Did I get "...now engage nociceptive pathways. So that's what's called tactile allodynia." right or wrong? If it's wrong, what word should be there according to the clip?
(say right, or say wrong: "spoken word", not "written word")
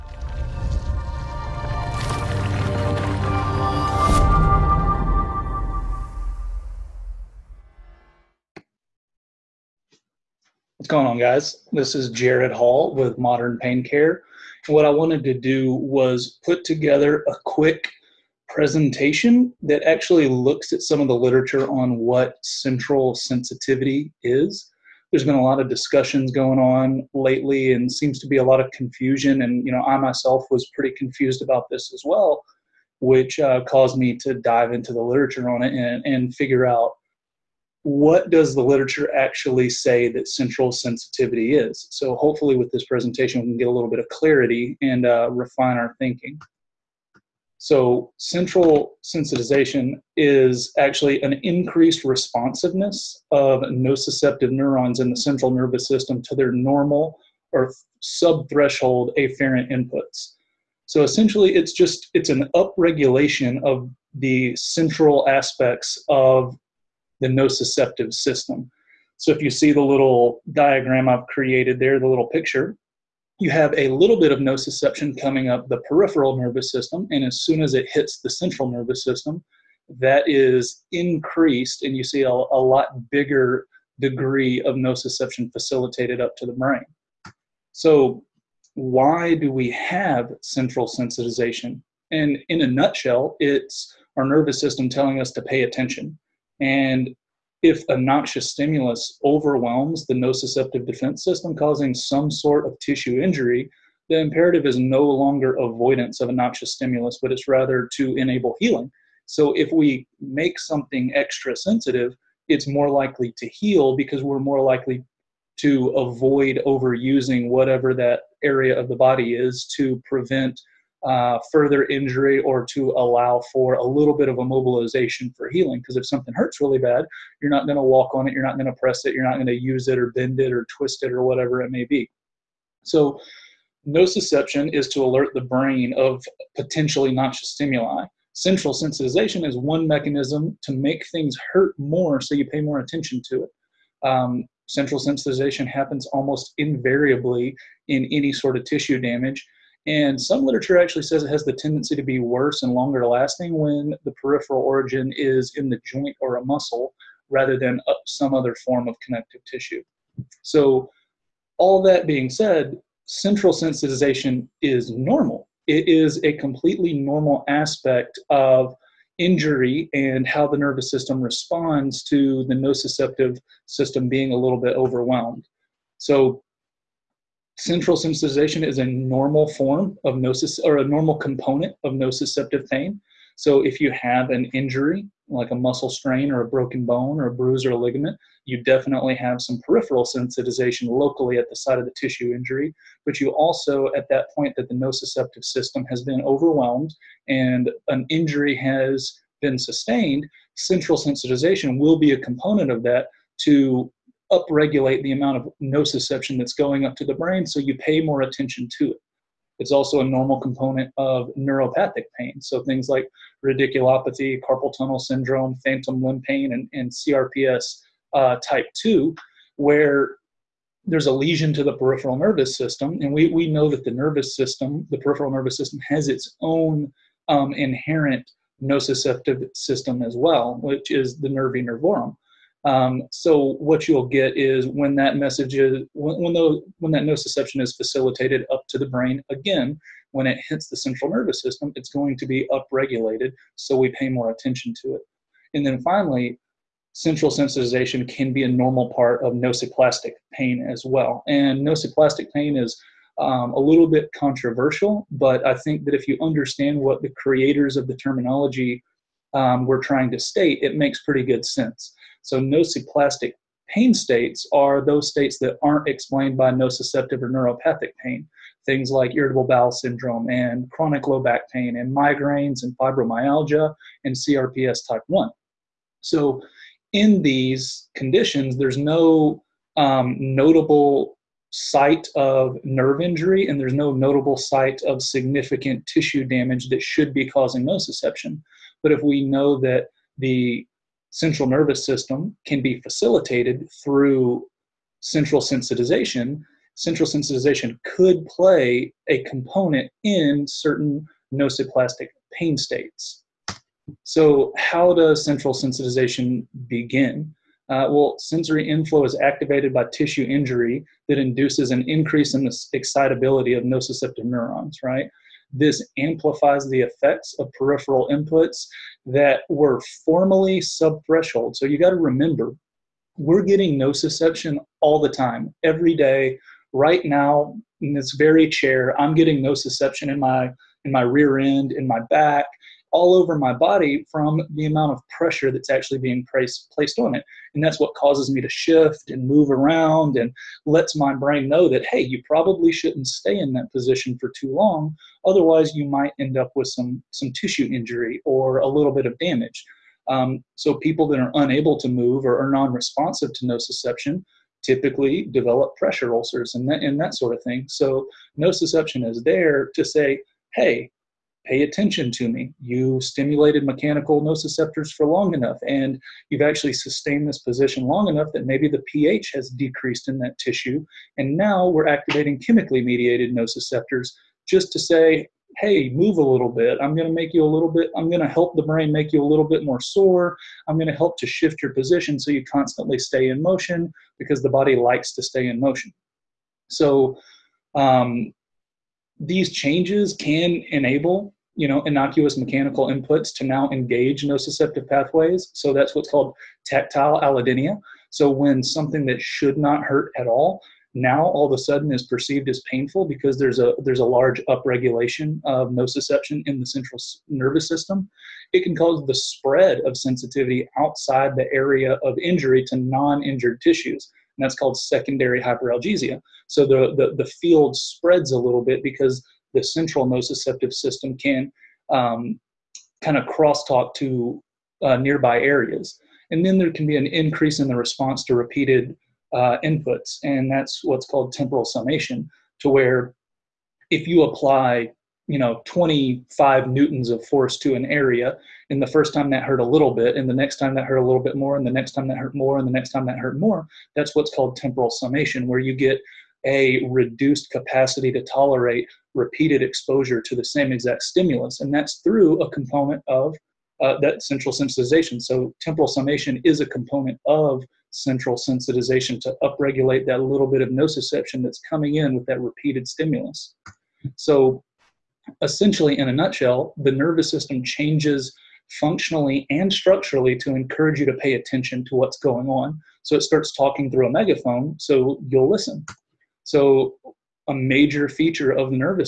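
right.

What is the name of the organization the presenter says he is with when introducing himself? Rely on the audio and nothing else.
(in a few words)
Modern Pain Care.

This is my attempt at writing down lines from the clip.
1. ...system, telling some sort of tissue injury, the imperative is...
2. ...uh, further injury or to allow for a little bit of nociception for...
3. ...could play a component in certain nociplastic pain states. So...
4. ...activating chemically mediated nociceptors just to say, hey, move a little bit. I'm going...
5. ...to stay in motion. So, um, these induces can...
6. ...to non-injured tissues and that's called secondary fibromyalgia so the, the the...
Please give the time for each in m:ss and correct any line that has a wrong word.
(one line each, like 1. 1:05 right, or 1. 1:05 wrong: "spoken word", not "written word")
1. 1:41 wrong: "causing", not "telling"
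2. 2:01 wrong: "immobilization", not "nociception"
3. 4:57 right
4. 6:11 right
5. 6:25 wrong: "changes", not "induces"
6. 6:52 wrong: "hyperalgesia", not "fibromyalgia".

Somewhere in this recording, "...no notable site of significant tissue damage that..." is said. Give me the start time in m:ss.
4:43.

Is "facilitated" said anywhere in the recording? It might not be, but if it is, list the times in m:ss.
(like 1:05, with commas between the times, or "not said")
1:25, 3:57, 4:52.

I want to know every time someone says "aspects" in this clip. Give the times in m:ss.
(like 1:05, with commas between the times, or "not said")
1:05, 2:47.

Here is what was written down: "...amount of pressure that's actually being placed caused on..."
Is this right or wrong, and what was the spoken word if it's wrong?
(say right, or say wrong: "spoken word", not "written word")
wrong: "placed", not "caused".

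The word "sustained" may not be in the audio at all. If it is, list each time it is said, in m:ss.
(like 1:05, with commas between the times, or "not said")
3:19, 6:06.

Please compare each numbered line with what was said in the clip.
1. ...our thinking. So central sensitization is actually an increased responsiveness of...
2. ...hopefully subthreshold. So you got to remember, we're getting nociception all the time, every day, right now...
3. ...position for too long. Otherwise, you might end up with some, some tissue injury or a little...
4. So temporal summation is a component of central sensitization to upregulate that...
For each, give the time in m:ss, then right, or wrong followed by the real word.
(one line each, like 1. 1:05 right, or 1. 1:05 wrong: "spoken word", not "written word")
1. 0:45 right
2. 5:20 wrong: "formerly", not "hopefully"
3. 5:43 right
4. 7:35 right.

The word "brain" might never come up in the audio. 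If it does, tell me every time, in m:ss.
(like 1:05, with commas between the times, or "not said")
1:26, 2:15, 3:27, 3:58, 5:41, 6:18.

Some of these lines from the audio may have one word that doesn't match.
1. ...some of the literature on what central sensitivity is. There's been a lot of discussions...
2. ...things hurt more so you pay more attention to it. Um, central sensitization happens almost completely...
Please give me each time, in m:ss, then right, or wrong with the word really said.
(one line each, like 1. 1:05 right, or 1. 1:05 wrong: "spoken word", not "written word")
1. 0:20 right
2. 2:21 wrong: "invariably", not "completely".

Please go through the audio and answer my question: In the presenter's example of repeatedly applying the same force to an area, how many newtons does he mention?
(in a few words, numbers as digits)
25.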